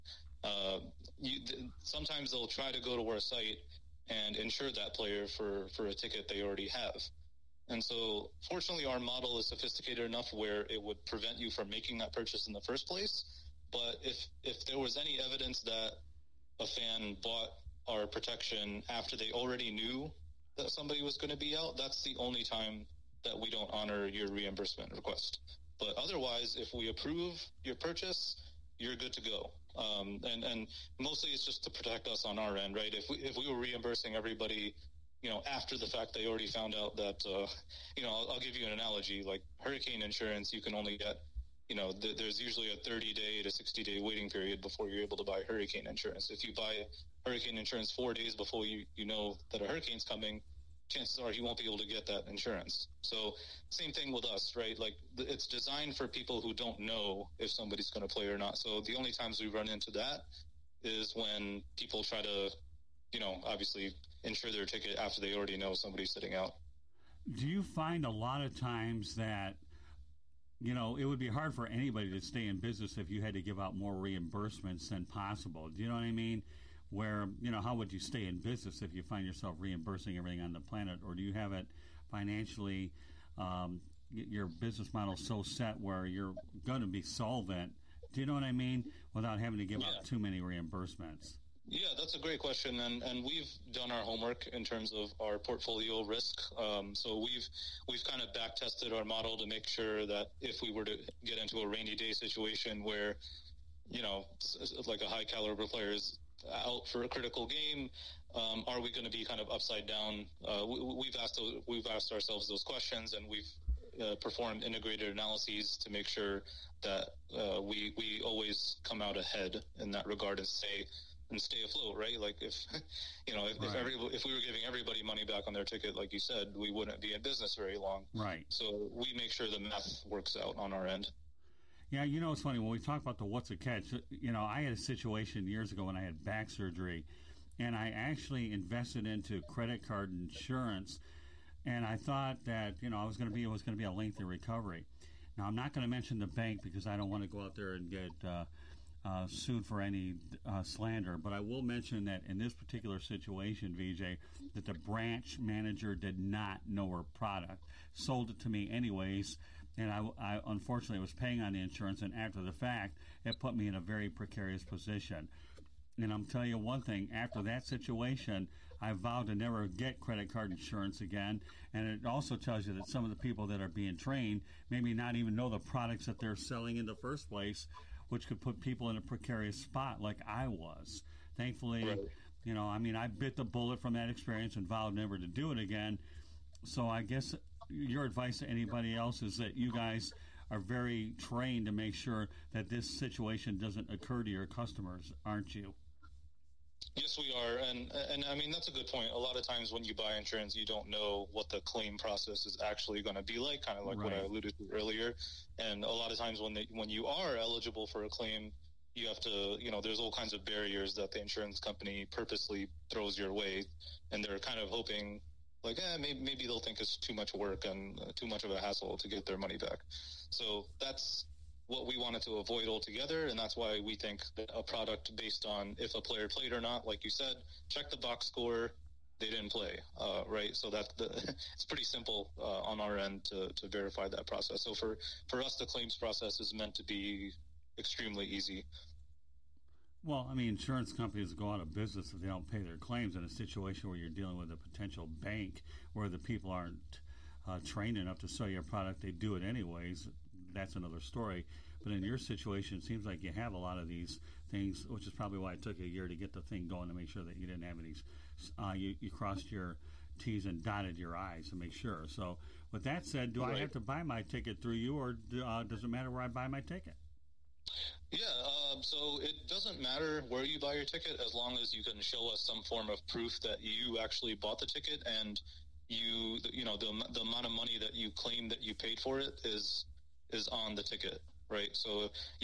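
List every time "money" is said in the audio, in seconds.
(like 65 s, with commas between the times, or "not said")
125 s, 219 s, 277 s.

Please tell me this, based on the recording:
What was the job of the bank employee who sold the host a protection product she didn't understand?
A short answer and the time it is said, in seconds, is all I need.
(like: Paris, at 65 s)
Branch manager, at 154 s.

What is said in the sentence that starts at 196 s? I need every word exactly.
Yes, we are, and and I mean that's a good point.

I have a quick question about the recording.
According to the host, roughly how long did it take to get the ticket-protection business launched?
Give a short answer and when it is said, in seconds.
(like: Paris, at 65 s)
A year, at 255 s.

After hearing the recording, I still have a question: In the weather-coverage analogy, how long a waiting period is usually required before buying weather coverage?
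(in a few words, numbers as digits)
30 to 60 days.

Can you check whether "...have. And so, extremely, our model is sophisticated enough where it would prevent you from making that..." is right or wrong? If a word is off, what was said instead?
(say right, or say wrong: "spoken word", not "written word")
wrong: "fortunately", not "extremely".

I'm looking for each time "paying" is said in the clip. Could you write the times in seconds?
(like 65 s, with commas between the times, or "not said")
161 s.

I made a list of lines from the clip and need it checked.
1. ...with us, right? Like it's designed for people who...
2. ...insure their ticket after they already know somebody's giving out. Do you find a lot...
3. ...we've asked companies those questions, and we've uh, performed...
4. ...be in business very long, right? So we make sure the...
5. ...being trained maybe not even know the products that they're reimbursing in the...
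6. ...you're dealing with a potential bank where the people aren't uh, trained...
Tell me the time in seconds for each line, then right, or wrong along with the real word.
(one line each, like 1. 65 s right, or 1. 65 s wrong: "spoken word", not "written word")
1. 54 s right
2. 64 s wrong: "sitting", not "giving"
3. 111 s wrong: "ourselves", not "companies"
4. 127 s right
5. 173 s wrong: "selling", not "reimbursing"
6. 243 s right.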